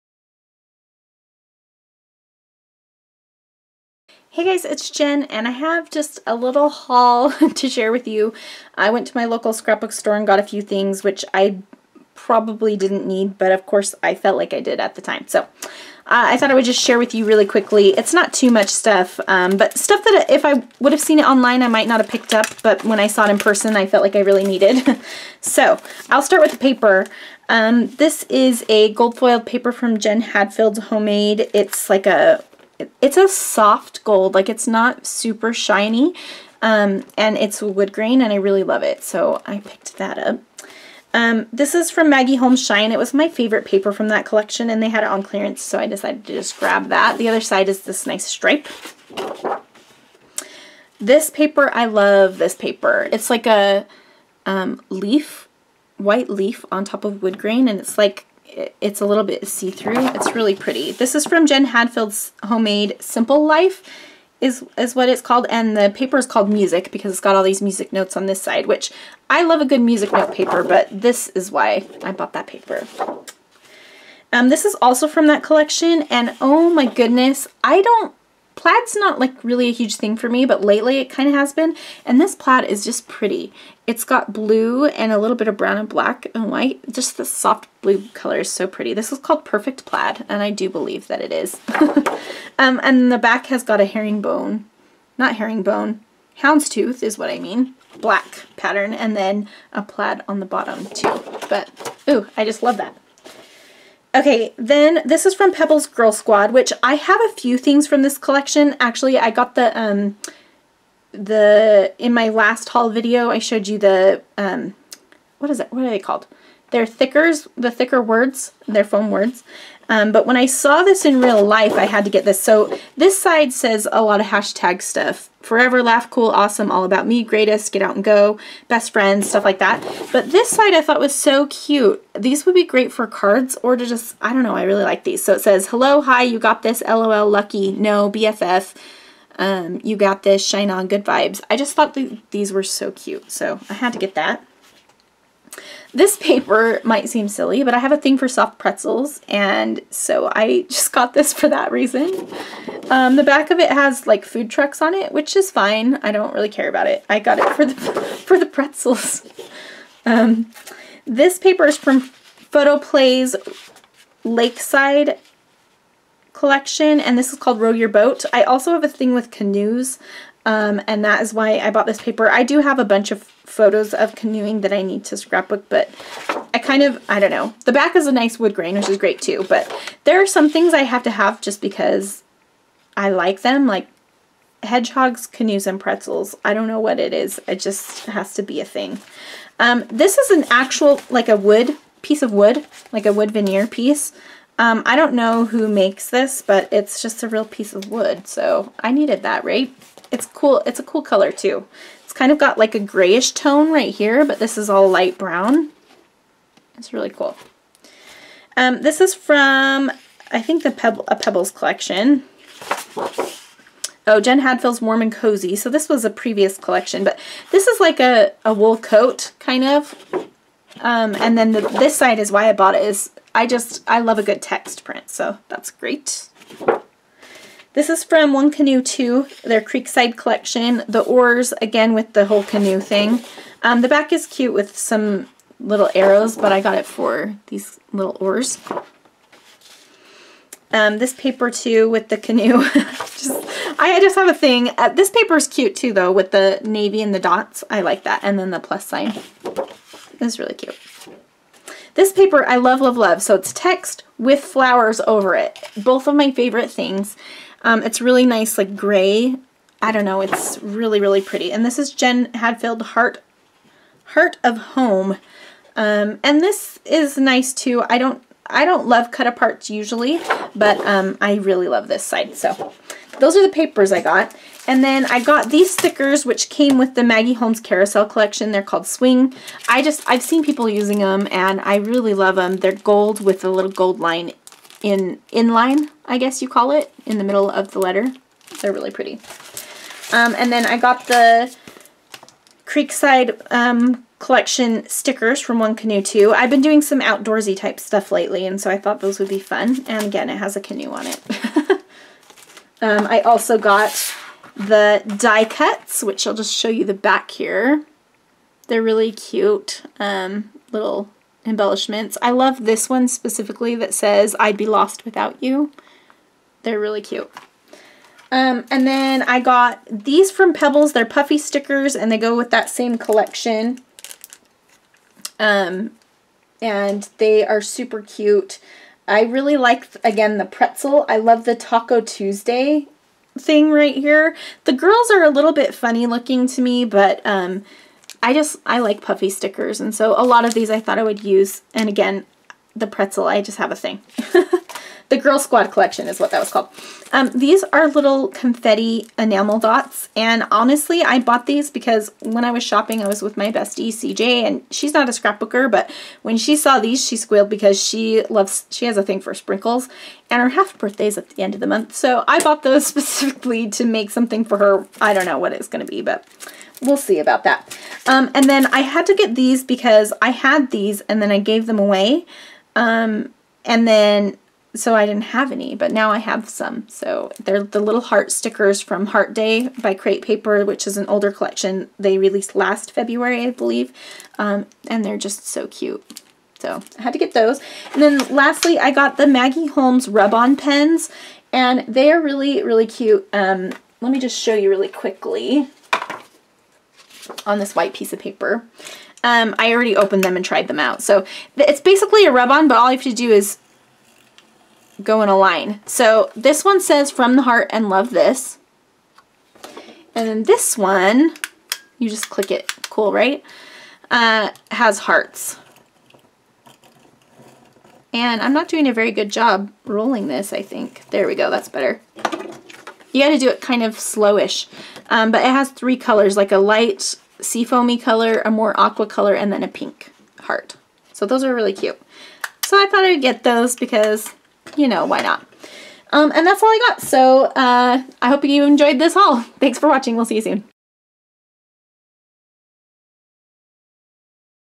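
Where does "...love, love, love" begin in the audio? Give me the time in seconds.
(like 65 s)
252 s.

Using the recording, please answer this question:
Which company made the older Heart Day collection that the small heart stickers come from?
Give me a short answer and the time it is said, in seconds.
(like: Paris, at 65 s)
Crate Paper, at 379 s.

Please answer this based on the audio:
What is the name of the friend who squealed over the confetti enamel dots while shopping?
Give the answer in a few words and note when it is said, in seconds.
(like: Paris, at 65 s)
CJ, at 353 s.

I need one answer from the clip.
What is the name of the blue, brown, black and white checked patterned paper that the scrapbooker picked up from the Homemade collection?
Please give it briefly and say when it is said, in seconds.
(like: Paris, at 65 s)
Perfect Plaid, at 89 s.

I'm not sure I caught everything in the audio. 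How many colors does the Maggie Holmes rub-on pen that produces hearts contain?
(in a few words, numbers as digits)
3.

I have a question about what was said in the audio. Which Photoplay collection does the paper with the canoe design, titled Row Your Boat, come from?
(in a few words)
Lakeside.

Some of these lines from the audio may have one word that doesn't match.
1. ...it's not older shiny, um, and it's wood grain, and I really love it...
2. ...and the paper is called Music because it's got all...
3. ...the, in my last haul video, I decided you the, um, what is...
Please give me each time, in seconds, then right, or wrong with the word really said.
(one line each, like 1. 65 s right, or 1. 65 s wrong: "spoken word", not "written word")
1. 34 s wrong: "super", not "older"
2. 65 s right
3. 111 s wrong: "showed", not "decided".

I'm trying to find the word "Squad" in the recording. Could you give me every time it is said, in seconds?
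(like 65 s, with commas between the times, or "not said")
106 s, 345 s.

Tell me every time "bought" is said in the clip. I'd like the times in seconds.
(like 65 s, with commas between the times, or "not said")
72 s, 171 s, 222 s, 351 s, 362 s.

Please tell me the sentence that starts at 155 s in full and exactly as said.
I don't really care about it.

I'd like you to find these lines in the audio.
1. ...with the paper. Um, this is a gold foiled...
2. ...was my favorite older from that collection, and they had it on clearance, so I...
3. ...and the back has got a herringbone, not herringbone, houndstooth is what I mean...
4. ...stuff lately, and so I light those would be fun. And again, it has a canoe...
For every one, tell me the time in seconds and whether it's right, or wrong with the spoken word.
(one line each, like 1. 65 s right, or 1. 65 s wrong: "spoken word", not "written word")
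1. 26 s right
2. 42 s wrong: "paper", not "older"
3. 92 s right
4. 297 s wrong: "thought", not "light".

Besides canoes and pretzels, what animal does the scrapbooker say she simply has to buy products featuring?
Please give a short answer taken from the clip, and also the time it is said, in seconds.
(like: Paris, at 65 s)
hedgehogs, at 184 s.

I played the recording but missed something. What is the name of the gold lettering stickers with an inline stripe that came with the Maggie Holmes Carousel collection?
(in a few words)
Swing.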